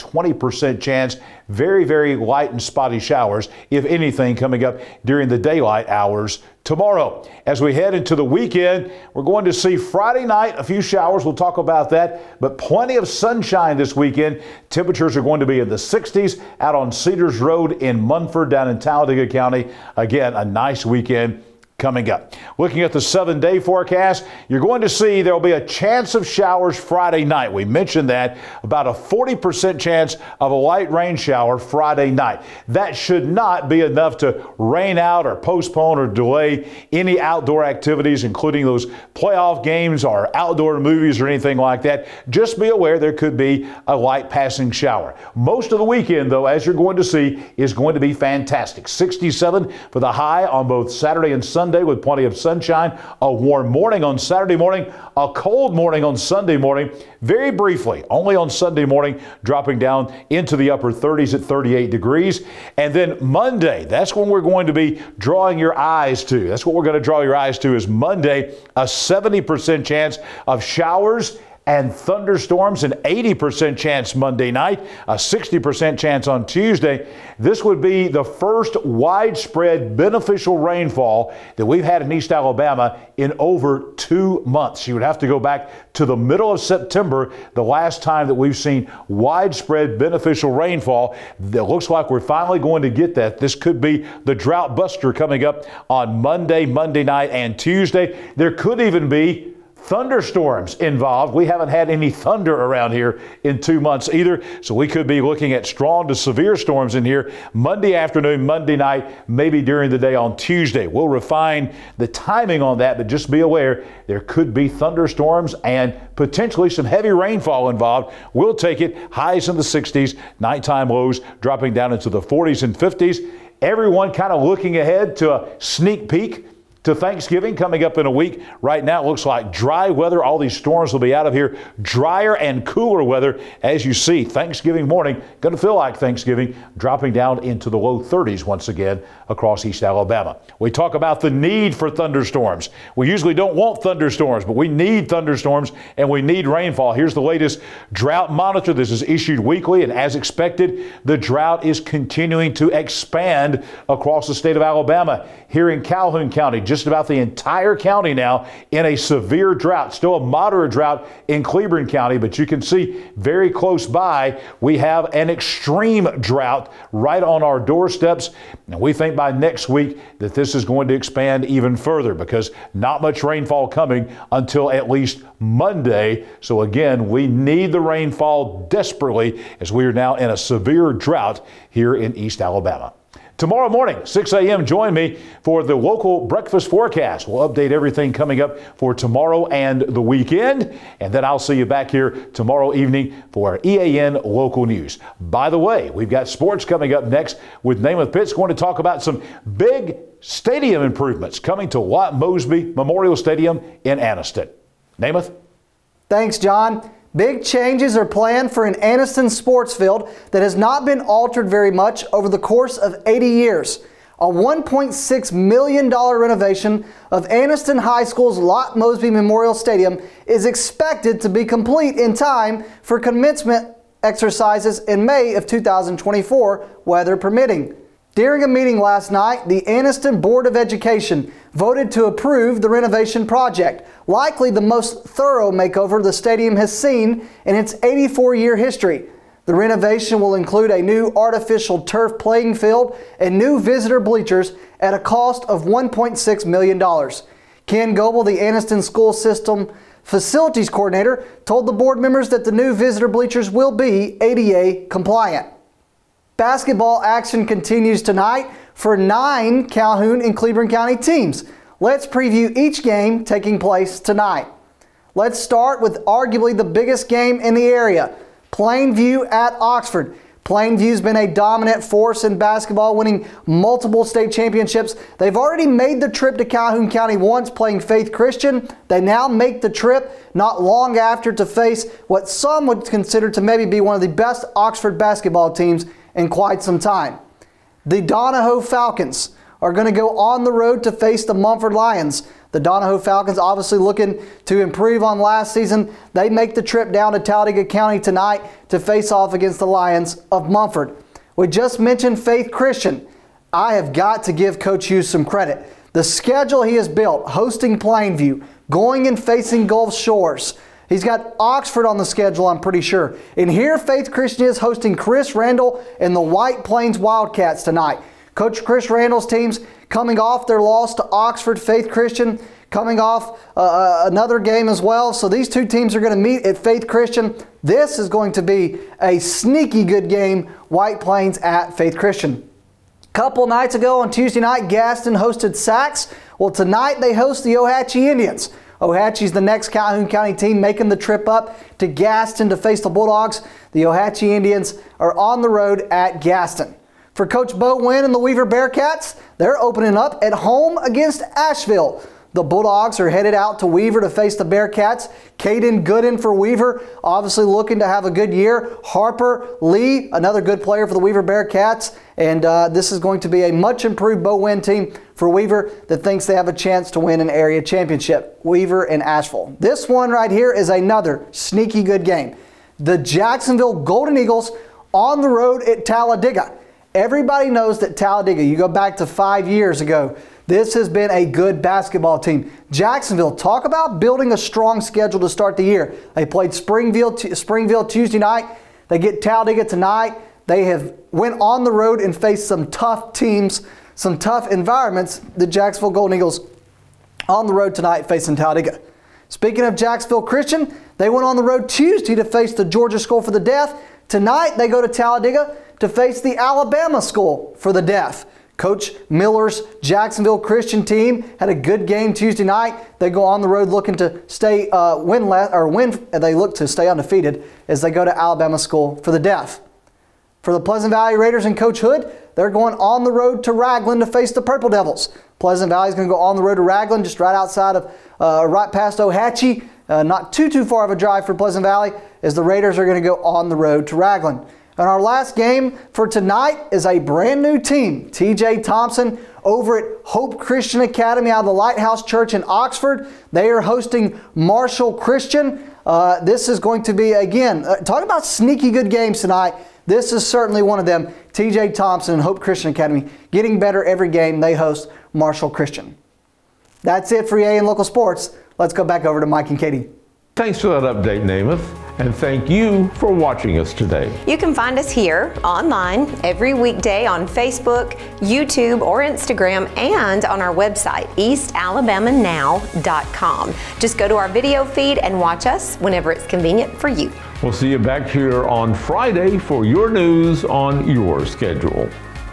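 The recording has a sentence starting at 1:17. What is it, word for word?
This would be the first widespread beneficial rainfall that we've had in East Alabama in over two months.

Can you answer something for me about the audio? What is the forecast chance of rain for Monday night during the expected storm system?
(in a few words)
80%.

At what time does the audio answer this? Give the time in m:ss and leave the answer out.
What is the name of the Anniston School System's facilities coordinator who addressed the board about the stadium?
4:07.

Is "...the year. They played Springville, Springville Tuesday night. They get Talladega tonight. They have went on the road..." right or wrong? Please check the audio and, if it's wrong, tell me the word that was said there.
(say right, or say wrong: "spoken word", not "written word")
right.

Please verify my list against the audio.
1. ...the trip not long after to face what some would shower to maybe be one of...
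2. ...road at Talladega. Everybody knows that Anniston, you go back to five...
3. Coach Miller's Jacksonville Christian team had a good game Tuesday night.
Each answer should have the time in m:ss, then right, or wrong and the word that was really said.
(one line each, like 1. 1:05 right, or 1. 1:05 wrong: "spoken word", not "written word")
1. 4:39 wrong: "consider", not "shower"
2. 6:15 wrong: "Talladega", not "Anniston"
3. 6:48 right.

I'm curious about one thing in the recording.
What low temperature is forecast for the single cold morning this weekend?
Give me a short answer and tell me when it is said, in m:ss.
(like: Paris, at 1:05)
38 degrees, at 1:01.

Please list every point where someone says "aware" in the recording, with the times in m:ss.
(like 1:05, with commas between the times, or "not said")
0:42, 1:53.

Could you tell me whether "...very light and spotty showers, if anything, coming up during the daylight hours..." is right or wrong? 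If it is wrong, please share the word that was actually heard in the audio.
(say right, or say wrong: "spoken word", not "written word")
right.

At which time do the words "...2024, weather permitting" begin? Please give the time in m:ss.
3:45.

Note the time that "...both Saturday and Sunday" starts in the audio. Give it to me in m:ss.
0:50.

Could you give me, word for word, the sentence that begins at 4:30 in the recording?
Plainview's been a dominant force in basketball, winning multiple state championships.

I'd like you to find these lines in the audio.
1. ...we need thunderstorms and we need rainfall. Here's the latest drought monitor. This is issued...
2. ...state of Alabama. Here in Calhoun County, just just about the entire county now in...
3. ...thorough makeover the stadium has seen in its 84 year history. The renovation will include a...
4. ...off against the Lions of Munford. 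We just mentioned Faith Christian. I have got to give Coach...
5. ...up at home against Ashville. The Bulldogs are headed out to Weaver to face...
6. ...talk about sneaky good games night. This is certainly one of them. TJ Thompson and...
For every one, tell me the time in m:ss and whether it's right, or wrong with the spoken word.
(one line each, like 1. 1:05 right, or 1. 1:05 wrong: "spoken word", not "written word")
1. 2:24 right
2. 2:34 right
3. 3:55 right
4. 4:59 right
5. 5:49 right
6. 7:27 wrong: "tonight", not "night".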